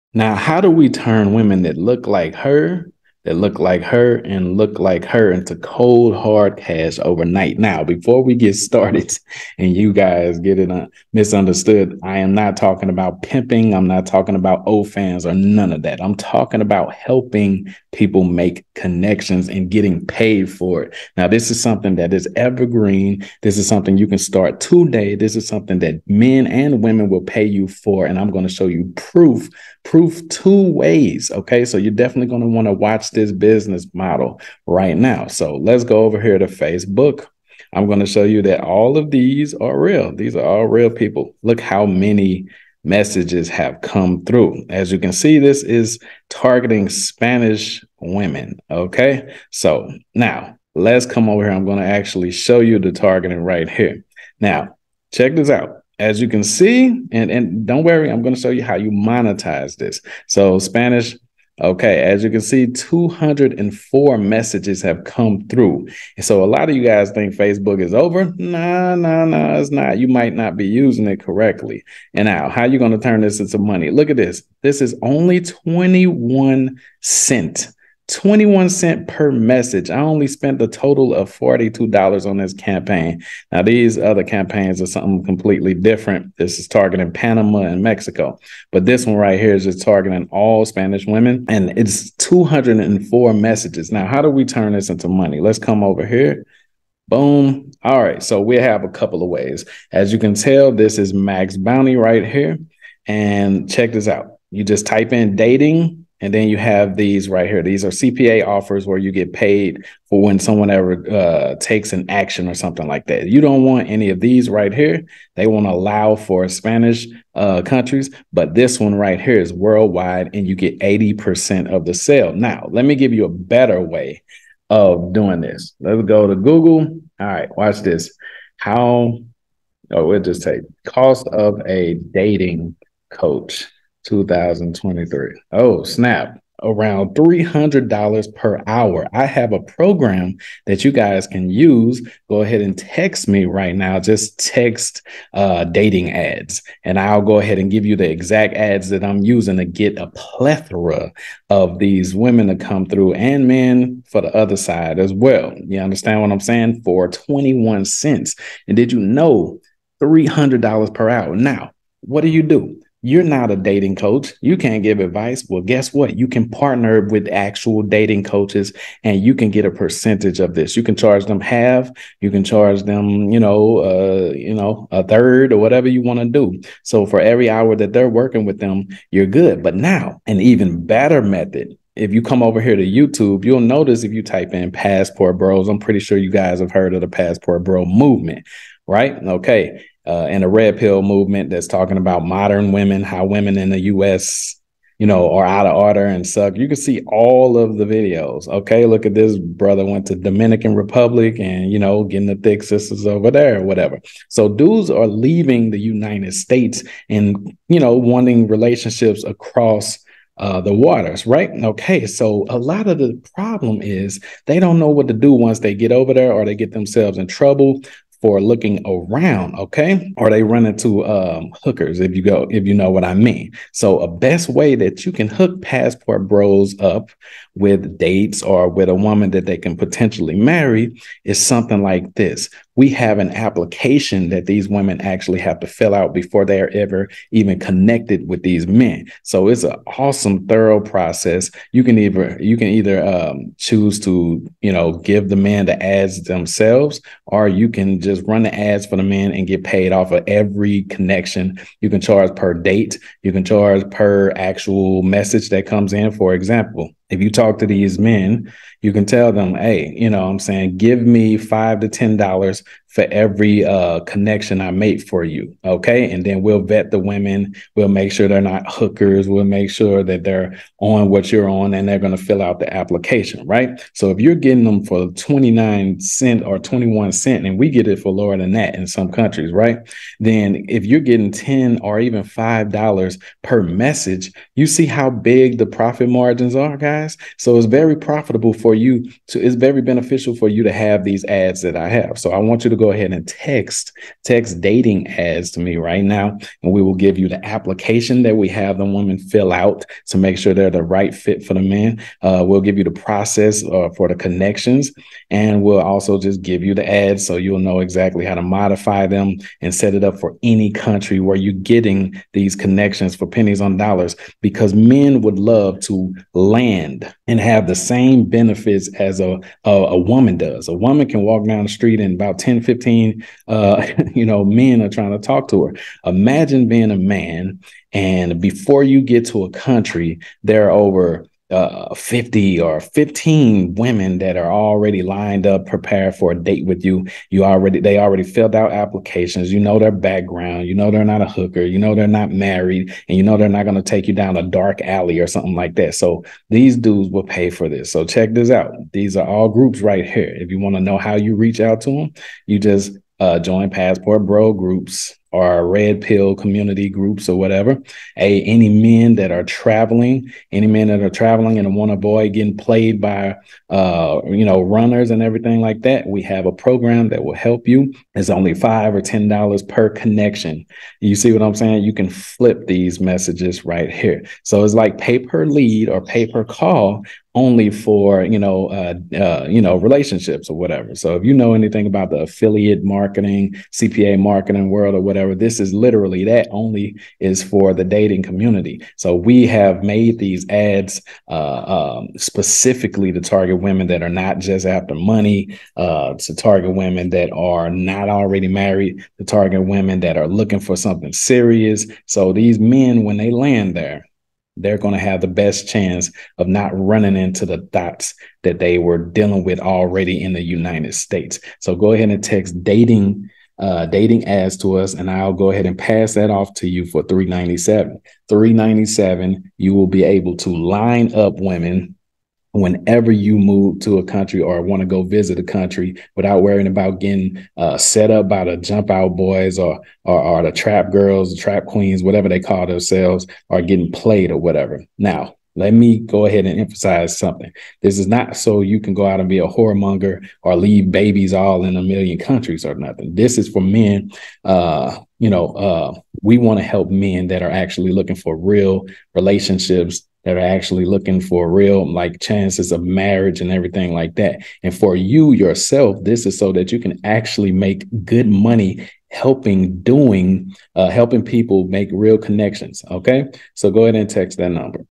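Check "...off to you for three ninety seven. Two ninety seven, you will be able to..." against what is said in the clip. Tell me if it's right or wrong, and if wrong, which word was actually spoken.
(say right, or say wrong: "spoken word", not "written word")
wrong: "Three", not "Two".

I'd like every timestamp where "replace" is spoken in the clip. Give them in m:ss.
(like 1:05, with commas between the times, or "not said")
not said.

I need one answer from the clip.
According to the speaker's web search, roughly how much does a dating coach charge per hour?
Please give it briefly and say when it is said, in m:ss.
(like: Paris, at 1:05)
$300, at 2:16.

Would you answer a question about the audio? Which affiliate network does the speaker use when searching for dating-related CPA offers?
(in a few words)
MaxBounty.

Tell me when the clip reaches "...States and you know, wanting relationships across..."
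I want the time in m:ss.
3:26.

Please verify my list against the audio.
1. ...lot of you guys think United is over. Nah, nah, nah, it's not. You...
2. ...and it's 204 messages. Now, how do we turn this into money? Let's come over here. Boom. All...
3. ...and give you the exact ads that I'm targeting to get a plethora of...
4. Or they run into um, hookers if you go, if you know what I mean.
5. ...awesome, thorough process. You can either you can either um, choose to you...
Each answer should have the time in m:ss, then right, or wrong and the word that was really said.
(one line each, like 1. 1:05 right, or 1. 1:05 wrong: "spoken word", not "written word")
1. 1:06 wrong: "Facebook", not "United"
2. 1:31 right
3. 2:27 wrong: "using", not "targeting"
4. 3:40 right
5. 3:59 right.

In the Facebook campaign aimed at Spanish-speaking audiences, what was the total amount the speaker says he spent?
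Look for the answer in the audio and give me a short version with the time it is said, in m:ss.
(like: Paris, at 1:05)
$42, at 1:21.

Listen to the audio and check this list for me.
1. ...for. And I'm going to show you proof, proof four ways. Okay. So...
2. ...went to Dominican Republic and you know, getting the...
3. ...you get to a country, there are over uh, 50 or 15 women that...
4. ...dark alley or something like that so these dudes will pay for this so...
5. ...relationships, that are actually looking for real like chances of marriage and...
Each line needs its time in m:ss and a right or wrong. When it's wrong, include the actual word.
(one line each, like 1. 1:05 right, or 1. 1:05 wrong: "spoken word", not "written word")
1. 0:27 wrong: "two", not "four"
2. 3:19 right
3. 5:28 right
4. 5:44 right
5. 7:29 right.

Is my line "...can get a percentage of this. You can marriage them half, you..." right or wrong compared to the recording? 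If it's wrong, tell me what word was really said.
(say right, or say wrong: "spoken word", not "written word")
wrong: "charge", not "marriage".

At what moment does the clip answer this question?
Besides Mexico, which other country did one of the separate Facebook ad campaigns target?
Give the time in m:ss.
1:27.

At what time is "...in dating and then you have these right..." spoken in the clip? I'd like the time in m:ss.
1:45.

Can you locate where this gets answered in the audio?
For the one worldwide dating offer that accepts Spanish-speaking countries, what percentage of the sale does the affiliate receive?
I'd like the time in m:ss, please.
2:00.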